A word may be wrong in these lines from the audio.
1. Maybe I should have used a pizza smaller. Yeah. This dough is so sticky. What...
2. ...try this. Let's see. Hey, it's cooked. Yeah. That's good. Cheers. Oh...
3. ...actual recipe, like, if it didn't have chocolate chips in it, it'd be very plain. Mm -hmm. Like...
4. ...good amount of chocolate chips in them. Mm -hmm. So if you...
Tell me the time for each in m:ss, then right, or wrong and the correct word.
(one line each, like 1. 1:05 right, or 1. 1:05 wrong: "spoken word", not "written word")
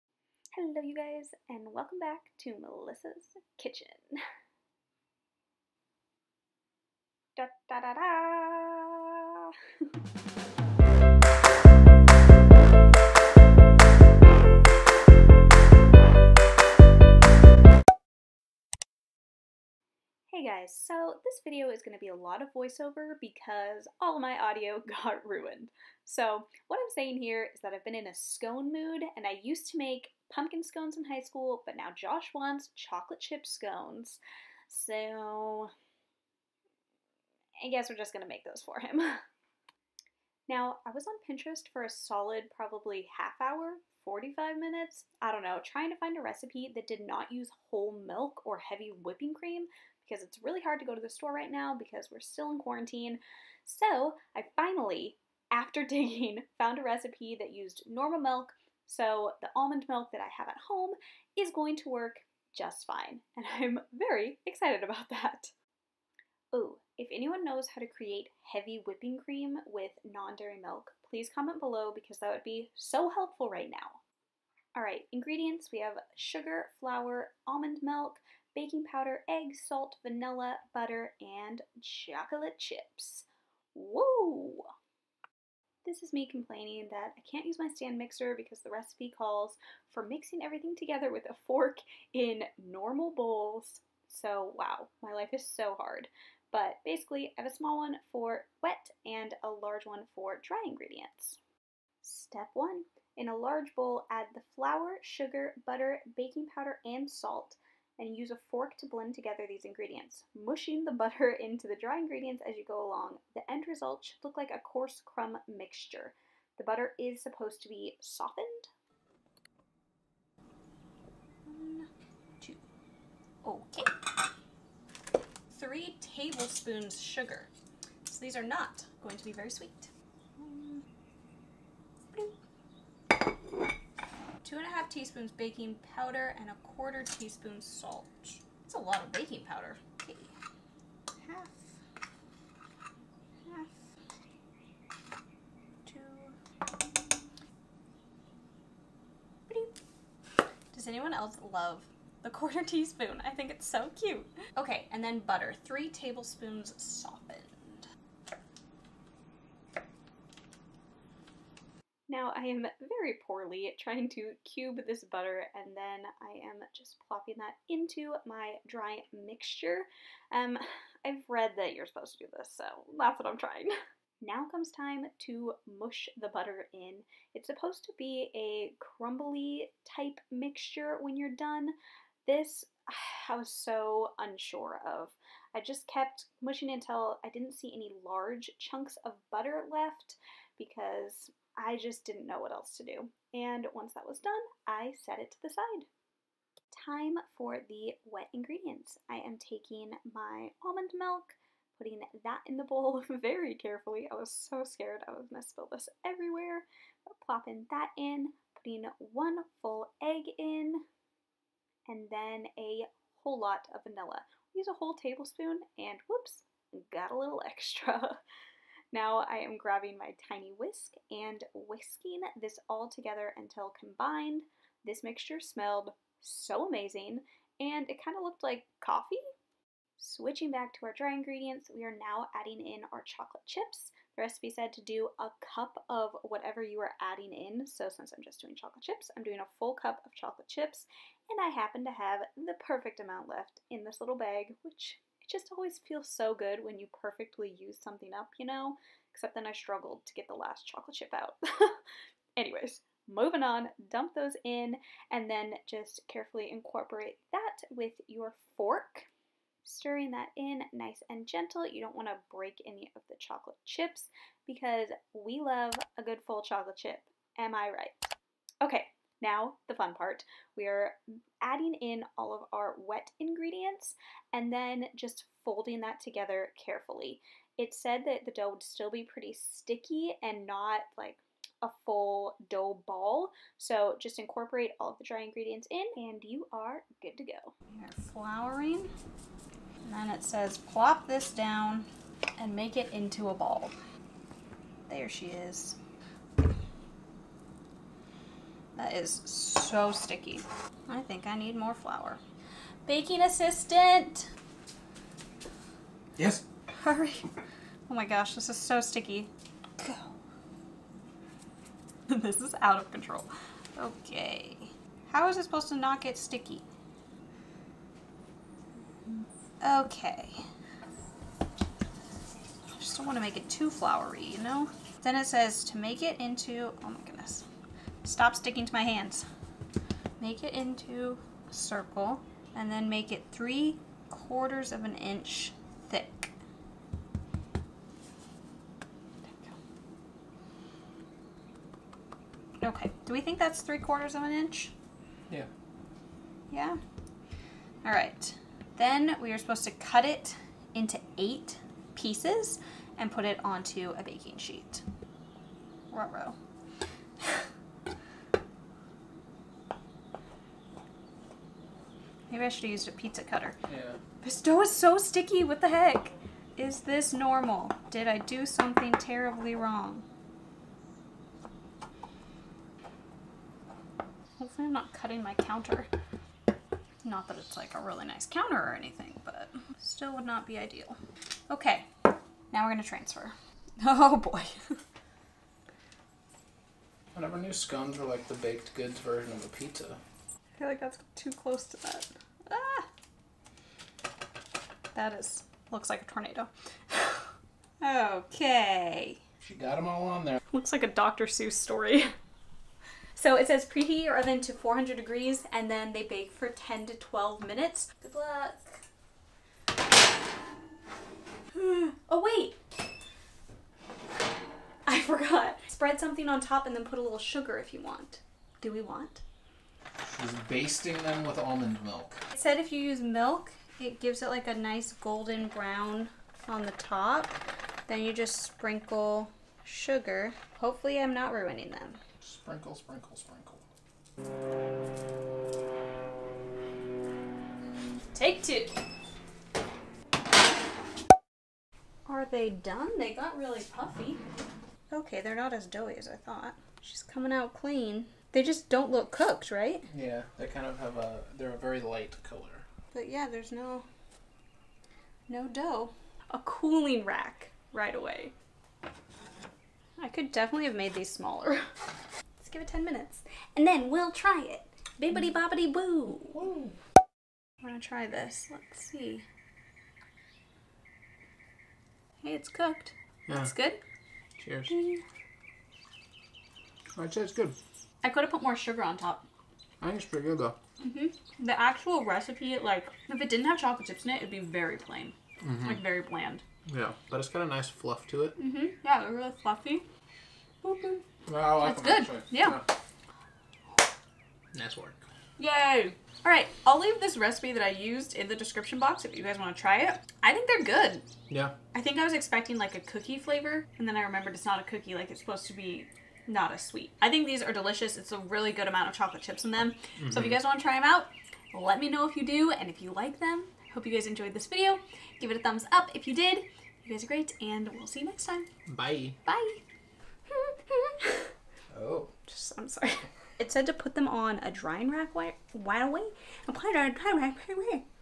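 1. 6:02 wrong: "cutter", not "smaller"
2. 7:47 right
3. 8:01 right
4. 8:28 right.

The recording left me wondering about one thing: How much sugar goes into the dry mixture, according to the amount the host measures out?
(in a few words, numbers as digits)
3 tablespoons.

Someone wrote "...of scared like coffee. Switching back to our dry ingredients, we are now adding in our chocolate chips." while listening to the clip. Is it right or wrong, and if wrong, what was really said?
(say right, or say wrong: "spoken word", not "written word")
wrong: "looked", not "scared".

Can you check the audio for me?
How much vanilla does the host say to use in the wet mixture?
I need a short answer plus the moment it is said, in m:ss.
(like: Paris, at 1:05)
1 tablespoon, at 3:34.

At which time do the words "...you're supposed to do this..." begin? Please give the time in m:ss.
2:51.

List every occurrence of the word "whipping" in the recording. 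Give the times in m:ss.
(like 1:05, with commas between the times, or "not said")
0:49, 1:08.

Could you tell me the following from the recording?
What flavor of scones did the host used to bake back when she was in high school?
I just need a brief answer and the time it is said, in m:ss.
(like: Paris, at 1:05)
Pumpkin, at 0:30.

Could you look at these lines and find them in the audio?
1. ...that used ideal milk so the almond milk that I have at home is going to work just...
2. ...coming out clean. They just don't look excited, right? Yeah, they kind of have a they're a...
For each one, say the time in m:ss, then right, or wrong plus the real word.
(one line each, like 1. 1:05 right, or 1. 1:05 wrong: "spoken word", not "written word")
1. 0:57 wrong: "normal", not "ideal"
2. 7:27 wrong: "cooked", not "excited".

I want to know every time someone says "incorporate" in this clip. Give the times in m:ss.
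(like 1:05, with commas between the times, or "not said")
4:16, 4:44.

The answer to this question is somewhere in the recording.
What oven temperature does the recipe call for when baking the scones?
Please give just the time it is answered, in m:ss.
6:44.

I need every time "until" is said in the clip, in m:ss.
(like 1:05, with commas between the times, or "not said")
3:06, 3:43.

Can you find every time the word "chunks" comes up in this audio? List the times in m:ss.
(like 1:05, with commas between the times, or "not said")
3:08.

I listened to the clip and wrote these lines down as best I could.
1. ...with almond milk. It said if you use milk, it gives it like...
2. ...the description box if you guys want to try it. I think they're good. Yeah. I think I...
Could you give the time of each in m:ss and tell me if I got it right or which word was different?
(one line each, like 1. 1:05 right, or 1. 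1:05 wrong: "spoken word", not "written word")
1. 7:01 right
2. 8:18 right.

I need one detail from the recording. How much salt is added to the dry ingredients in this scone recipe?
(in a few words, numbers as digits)
1/4 teaspoon.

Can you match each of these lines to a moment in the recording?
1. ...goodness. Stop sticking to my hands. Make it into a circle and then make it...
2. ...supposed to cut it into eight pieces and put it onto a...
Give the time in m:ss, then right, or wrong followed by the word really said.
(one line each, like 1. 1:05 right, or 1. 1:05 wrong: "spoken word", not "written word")
1. 5:27 right
2. 5:49 right.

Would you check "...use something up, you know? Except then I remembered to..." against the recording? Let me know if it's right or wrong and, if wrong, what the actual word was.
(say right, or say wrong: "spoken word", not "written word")
wrong: "struggled", not "remembered".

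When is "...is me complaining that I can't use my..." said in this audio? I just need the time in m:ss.
1:26.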